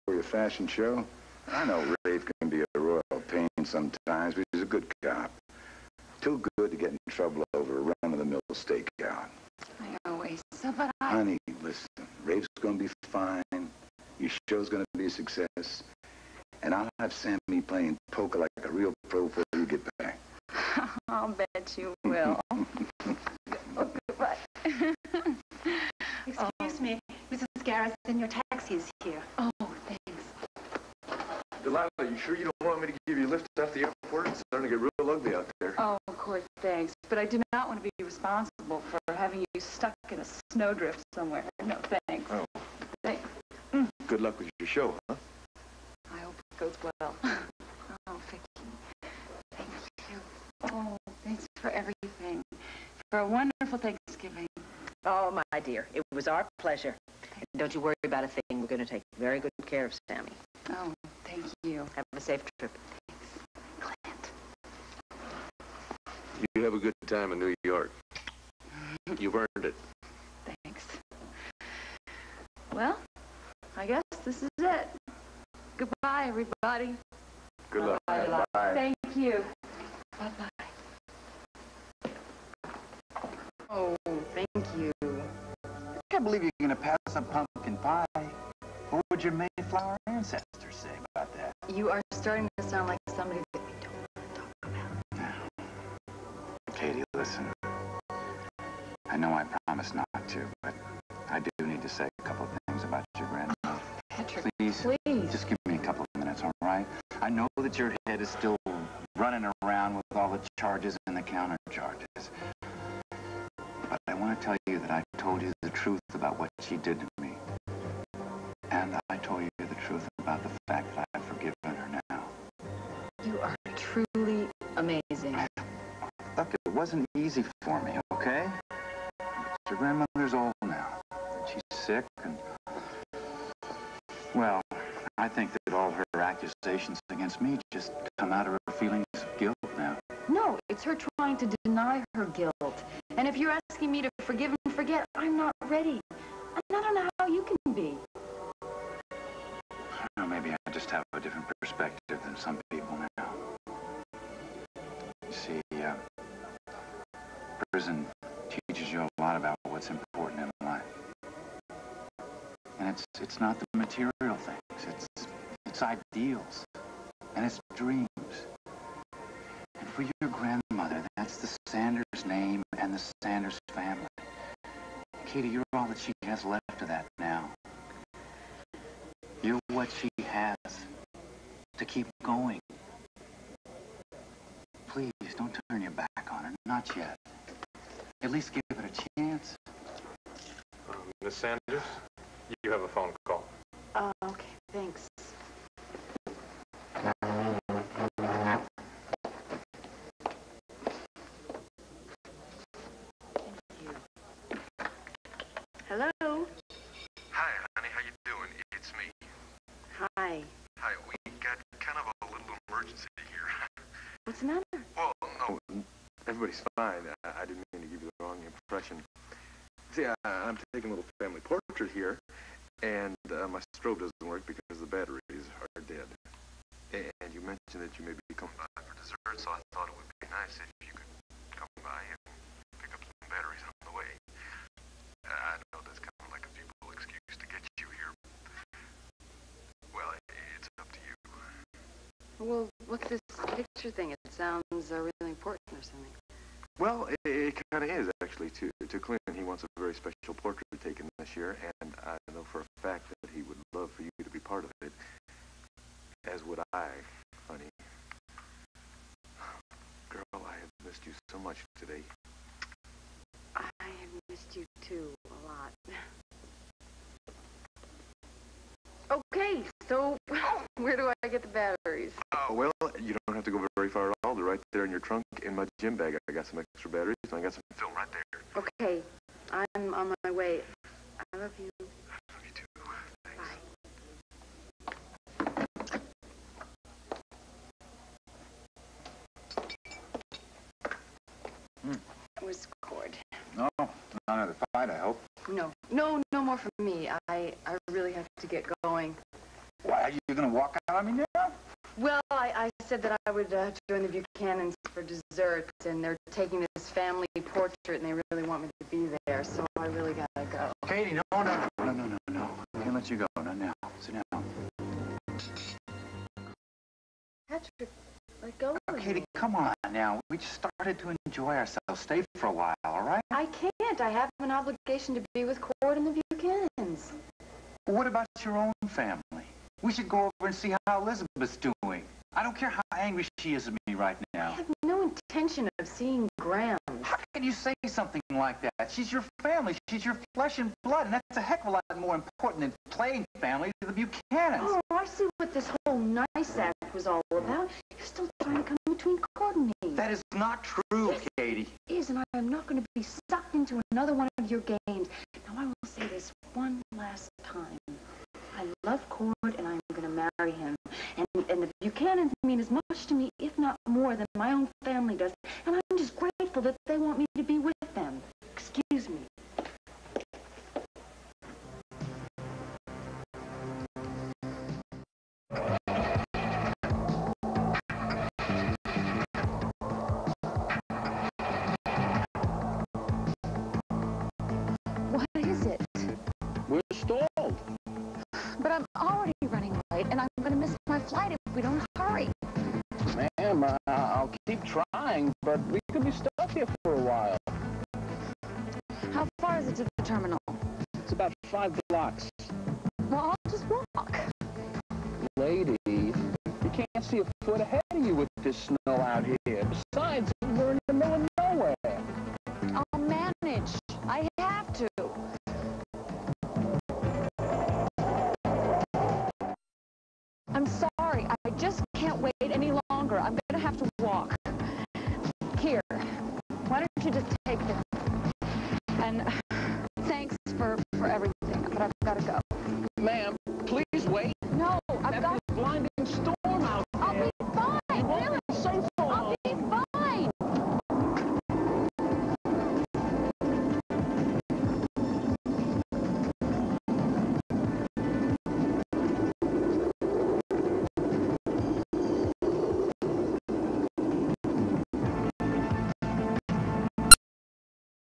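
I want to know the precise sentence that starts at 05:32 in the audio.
I don't care how angry she is at me right now.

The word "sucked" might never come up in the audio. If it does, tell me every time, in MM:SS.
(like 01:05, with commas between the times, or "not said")
05:53.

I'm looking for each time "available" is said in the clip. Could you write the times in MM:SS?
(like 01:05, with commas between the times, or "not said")
not said.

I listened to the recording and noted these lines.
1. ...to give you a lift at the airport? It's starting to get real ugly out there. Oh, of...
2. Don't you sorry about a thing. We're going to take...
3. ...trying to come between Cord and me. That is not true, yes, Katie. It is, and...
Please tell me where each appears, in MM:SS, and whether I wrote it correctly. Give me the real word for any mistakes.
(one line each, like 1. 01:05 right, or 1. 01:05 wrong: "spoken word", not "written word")
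1. 00:32 right
2. 00:57 wrong: "worry", not "sorry"
3. 05:48 right.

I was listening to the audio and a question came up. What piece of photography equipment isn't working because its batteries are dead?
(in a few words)
strobe.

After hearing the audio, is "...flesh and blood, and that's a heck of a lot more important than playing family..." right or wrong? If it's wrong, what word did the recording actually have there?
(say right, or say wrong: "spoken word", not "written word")
right.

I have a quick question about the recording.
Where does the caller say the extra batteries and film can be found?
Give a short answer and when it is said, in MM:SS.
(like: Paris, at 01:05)
gym bag, at 04:35.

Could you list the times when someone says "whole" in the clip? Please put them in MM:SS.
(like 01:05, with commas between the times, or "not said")
05:45.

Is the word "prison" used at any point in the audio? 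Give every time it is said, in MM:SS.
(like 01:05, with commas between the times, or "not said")
02:37.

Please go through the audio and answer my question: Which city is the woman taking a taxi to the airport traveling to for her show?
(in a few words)
New York.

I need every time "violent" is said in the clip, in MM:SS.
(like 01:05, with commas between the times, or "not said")
not said.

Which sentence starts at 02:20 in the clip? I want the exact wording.
No, it's her trying to deny her guilt.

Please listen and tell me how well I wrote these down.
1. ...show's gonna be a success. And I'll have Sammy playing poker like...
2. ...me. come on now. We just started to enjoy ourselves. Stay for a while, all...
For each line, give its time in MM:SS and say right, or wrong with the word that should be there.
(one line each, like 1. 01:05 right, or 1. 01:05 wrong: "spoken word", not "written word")
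1. 00:14 right
2. 05:19 right.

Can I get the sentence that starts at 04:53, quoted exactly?
No, not another fight, I hope.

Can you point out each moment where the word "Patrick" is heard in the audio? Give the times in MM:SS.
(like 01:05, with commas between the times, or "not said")
01:44, 05:17.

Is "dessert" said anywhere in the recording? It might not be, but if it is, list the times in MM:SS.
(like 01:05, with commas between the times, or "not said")
03:48, 05:05.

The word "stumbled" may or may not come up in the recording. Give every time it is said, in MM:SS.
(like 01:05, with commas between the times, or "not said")
not said.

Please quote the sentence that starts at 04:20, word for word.
Girl, I have missed you so much today.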